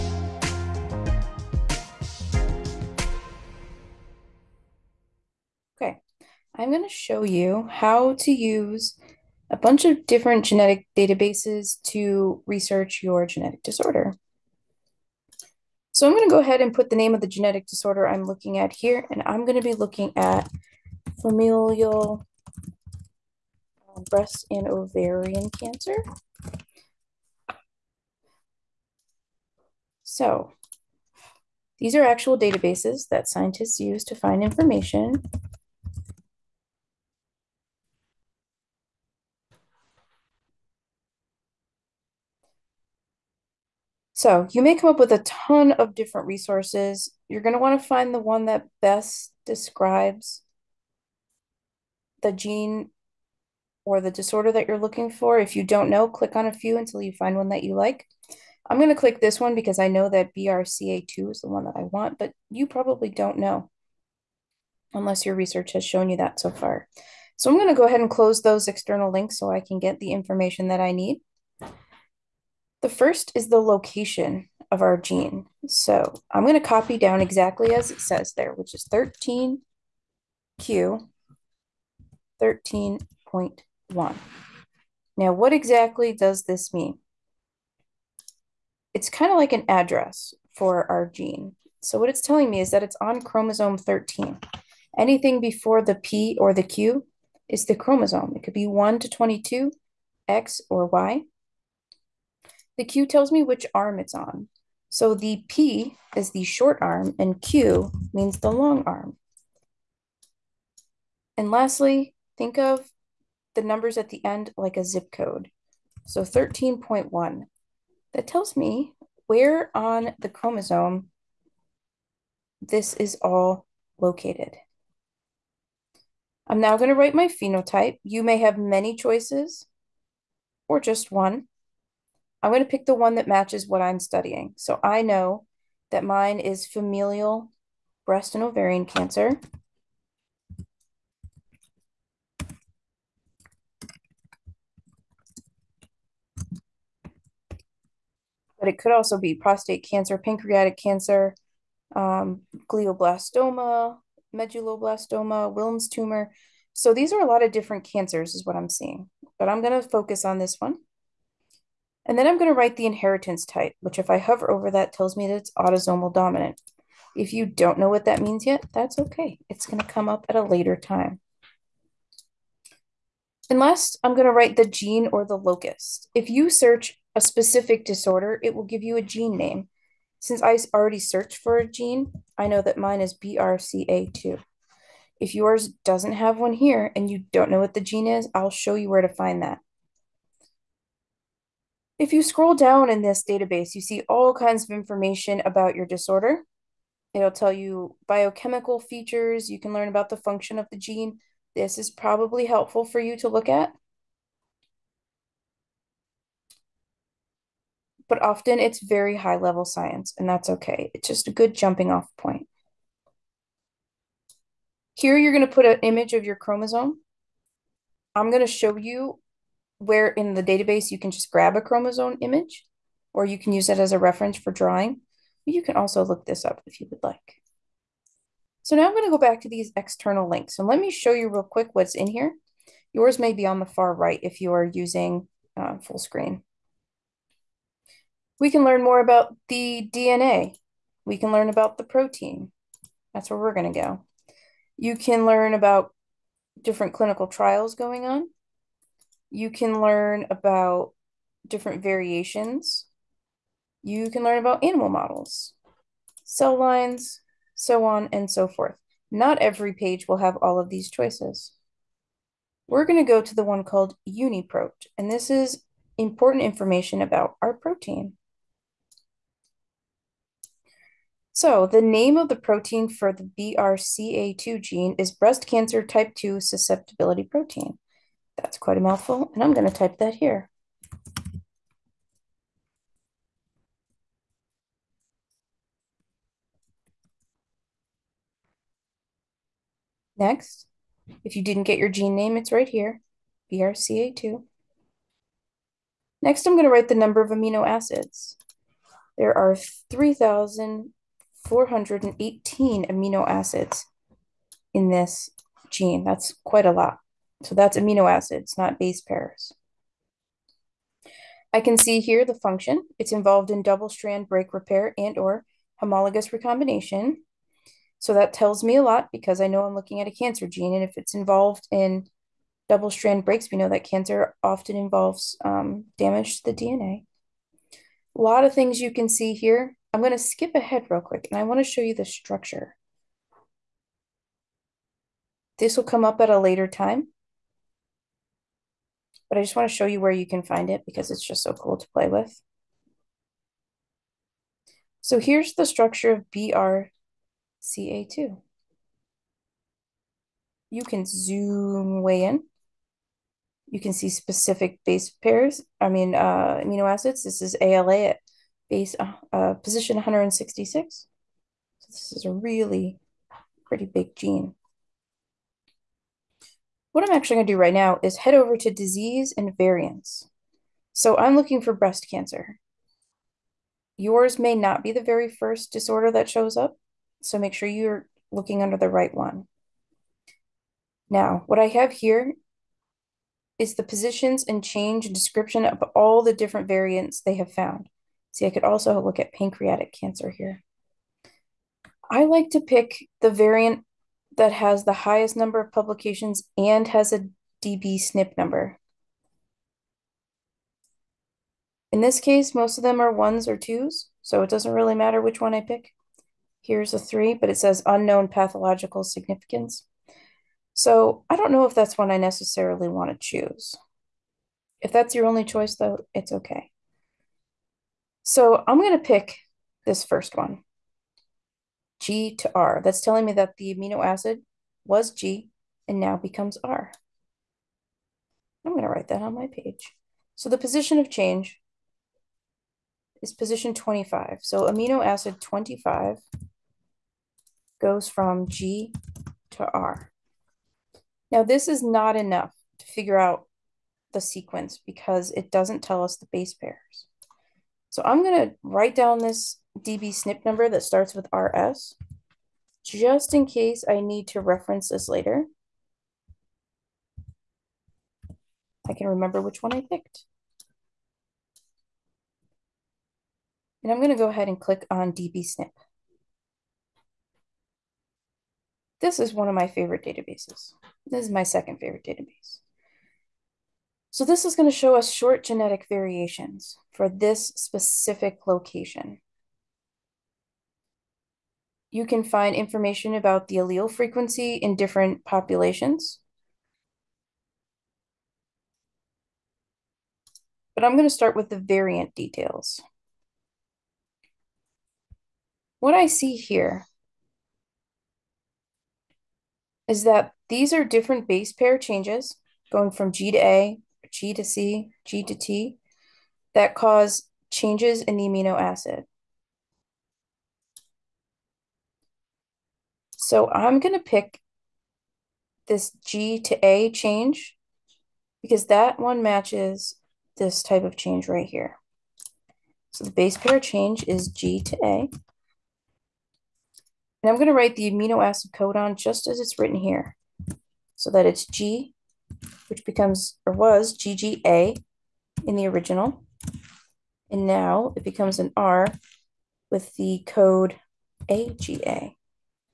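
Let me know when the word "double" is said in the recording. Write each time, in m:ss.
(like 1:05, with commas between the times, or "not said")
5:13, 5:22.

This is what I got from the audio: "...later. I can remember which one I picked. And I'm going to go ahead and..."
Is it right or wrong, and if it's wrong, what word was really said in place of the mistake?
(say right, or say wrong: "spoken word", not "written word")
right.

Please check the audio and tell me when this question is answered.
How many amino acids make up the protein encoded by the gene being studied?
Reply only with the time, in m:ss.
4:59.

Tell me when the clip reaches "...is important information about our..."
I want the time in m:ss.
4:25.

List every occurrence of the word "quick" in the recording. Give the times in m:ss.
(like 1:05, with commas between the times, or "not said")
3:51, 5:31.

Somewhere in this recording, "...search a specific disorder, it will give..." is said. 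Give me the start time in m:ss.
2:56.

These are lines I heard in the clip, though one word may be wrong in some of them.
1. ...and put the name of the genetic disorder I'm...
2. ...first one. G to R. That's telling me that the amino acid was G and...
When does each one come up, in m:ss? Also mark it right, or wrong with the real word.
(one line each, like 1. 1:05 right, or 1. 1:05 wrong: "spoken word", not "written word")
1. 0:16 right
2. 7:00 right.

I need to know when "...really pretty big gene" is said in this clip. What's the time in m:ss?
6:02.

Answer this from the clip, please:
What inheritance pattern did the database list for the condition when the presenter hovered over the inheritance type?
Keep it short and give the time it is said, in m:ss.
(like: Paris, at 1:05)
Autosomal dominant, at 2:45.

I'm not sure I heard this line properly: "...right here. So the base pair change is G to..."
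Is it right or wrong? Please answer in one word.
right.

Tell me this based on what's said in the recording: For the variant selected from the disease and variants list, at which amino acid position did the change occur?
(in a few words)
25.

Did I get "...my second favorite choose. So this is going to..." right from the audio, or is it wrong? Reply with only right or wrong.
wrong.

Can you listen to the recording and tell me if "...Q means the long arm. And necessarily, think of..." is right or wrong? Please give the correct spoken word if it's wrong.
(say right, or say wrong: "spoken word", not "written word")
wrong: "lastly", not "necessarily".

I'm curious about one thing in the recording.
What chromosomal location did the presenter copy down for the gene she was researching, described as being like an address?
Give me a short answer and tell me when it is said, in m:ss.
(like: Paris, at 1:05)
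13q 13.1, at 1:18.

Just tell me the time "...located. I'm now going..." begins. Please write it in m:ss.
2:03.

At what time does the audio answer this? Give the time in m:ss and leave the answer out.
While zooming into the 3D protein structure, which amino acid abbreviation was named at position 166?
5:57.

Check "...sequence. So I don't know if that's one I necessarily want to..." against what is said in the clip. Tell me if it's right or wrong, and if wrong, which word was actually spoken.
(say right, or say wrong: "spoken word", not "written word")
wrong: "significance", not "sequence".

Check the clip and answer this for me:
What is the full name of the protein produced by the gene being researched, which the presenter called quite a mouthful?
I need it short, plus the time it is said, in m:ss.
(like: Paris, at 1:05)
Breast cancer type 2 susceptibility protein, at 4:35.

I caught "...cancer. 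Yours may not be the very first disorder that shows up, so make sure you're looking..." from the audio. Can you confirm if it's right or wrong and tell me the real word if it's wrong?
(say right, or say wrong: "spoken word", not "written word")
right.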